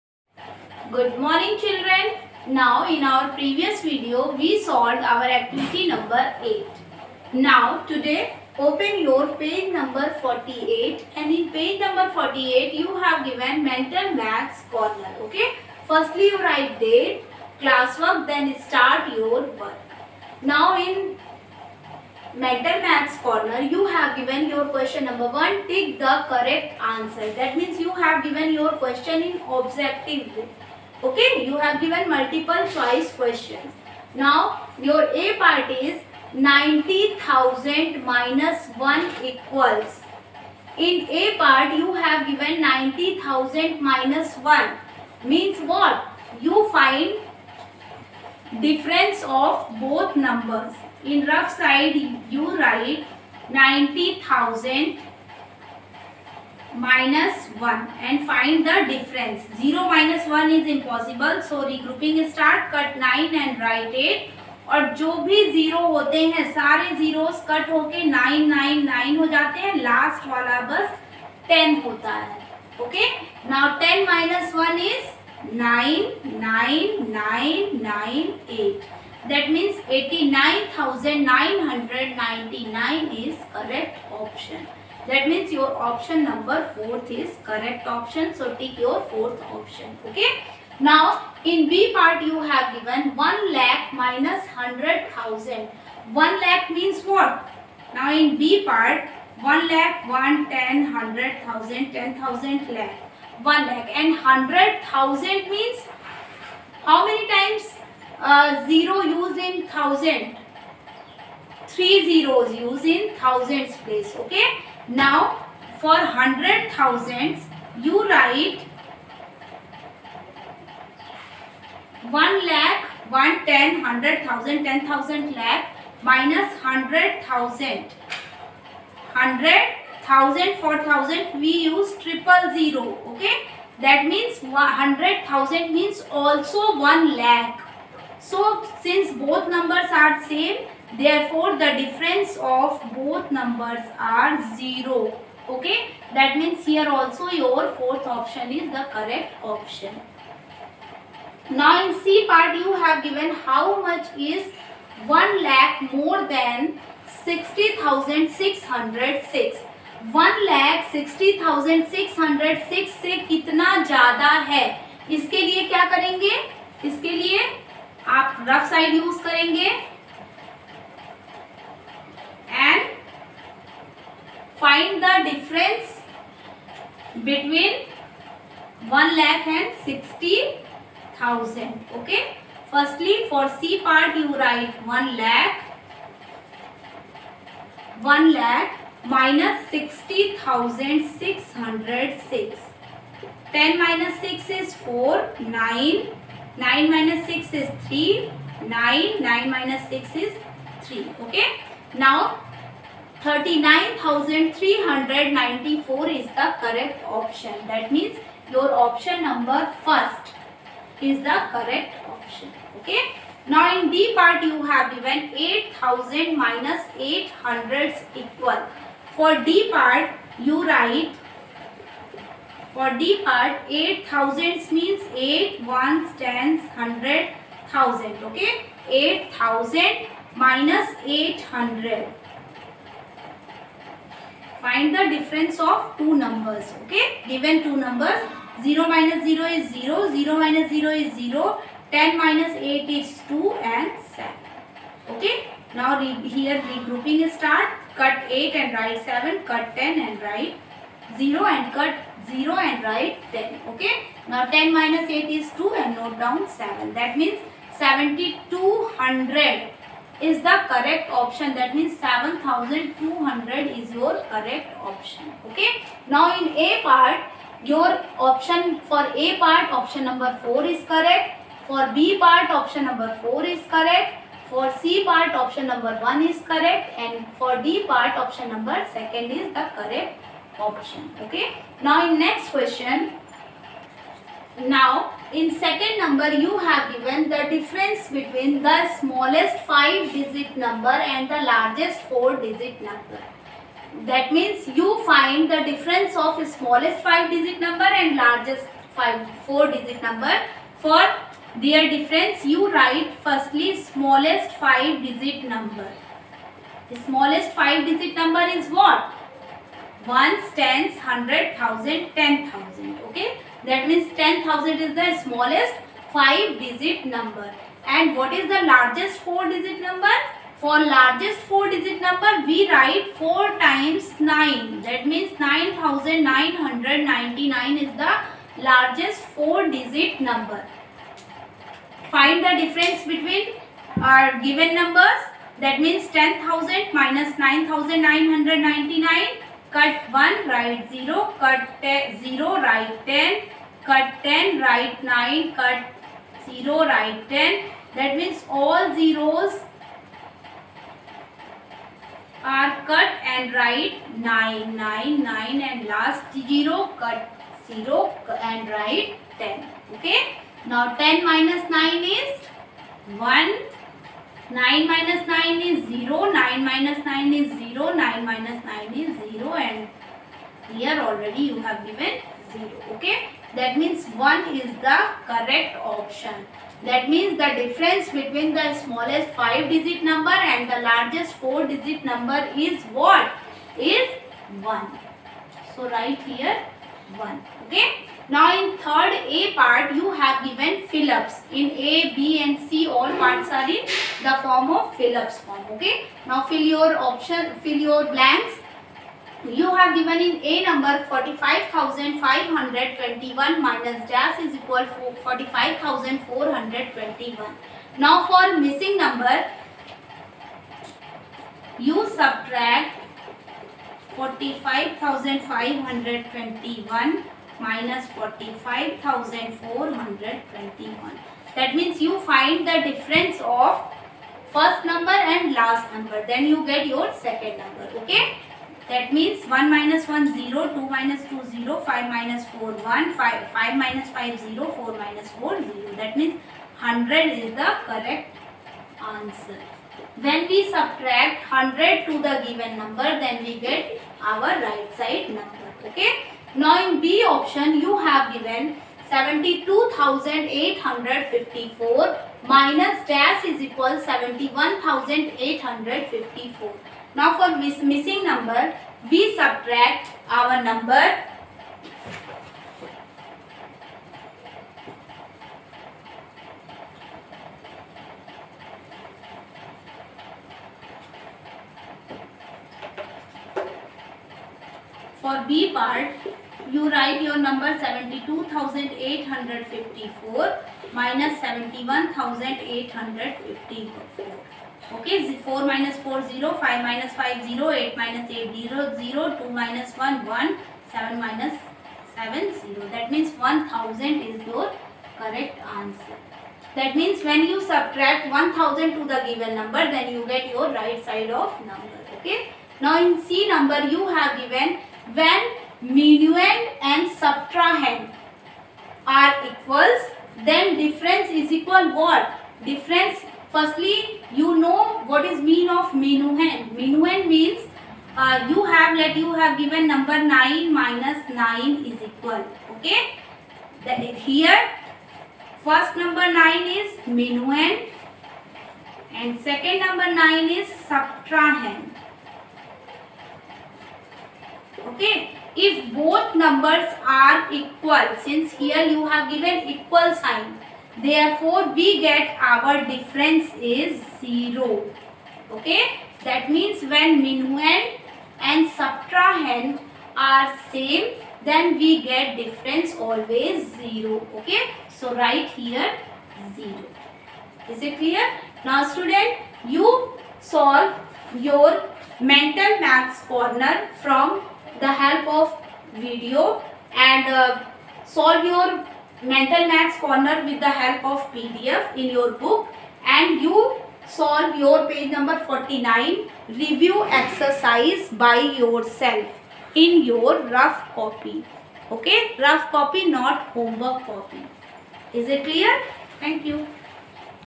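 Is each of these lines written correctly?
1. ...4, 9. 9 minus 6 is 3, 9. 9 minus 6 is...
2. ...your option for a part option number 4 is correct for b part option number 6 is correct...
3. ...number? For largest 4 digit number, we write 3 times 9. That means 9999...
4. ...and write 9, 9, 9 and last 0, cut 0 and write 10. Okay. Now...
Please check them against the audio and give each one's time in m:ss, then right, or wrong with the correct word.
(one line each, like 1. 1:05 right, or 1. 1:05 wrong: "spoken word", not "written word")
1. 3:14 right
2. 4:27 wrong: "4", not "6"
3. 5:19 wrong: "4", not "3"
4. 5:53 right.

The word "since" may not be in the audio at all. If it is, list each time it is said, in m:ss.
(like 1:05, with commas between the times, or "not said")
2:18, 8:58.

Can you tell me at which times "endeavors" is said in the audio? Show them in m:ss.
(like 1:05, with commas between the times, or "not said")
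not said.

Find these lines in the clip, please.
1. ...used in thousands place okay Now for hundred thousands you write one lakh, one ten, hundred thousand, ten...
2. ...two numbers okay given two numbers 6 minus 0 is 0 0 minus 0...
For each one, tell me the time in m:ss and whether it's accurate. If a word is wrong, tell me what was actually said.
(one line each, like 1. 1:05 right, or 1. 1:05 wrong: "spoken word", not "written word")
1. 1:52 right
2. 3:55 wrong: "0", not "6".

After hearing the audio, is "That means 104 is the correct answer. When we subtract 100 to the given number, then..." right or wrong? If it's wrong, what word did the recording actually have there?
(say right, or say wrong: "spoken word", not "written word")
wrong: "100", not "104".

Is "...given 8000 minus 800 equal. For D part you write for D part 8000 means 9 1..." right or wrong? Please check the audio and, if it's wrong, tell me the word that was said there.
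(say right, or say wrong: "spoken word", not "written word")
wrong: "8", not "9".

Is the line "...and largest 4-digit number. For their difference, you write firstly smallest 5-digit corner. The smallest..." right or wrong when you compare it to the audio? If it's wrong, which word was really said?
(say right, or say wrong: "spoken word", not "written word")
wrong: "number", not "corner".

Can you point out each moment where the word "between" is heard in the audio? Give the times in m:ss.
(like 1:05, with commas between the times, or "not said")
2:57, 4:48, 5:33, 6:18.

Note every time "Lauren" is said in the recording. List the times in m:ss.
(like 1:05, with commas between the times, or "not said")
not said.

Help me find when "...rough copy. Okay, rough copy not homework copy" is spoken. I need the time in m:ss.
9:40.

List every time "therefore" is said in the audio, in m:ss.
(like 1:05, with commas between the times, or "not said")
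2:20, 9:00.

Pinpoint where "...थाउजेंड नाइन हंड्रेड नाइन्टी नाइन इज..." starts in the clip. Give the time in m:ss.
1:20.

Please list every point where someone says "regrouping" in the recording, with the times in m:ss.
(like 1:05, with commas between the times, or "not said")
1:01, 4:06.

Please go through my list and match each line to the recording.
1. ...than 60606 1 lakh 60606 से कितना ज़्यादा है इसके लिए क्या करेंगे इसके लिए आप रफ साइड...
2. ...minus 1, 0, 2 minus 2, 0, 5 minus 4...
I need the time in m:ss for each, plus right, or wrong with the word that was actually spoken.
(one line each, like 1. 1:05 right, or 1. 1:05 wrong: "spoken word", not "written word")
1. 2:36 right
2. 7:09 right.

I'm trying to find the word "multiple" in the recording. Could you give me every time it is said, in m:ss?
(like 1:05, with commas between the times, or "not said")
0:32.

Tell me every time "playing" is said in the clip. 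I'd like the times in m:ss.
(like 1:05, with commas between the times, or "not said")
not said.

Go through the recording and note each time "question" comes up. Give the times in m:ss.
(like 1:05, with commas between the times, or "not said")
0:24, 0:28, 0:33, 4:42.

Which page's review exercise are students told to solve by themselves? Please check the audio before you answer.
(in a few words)
49.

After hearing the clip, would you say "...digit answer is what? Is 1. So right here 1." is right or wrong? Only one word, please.
wrong.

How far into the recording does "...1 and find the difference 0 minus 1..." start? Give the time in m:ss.
0:57.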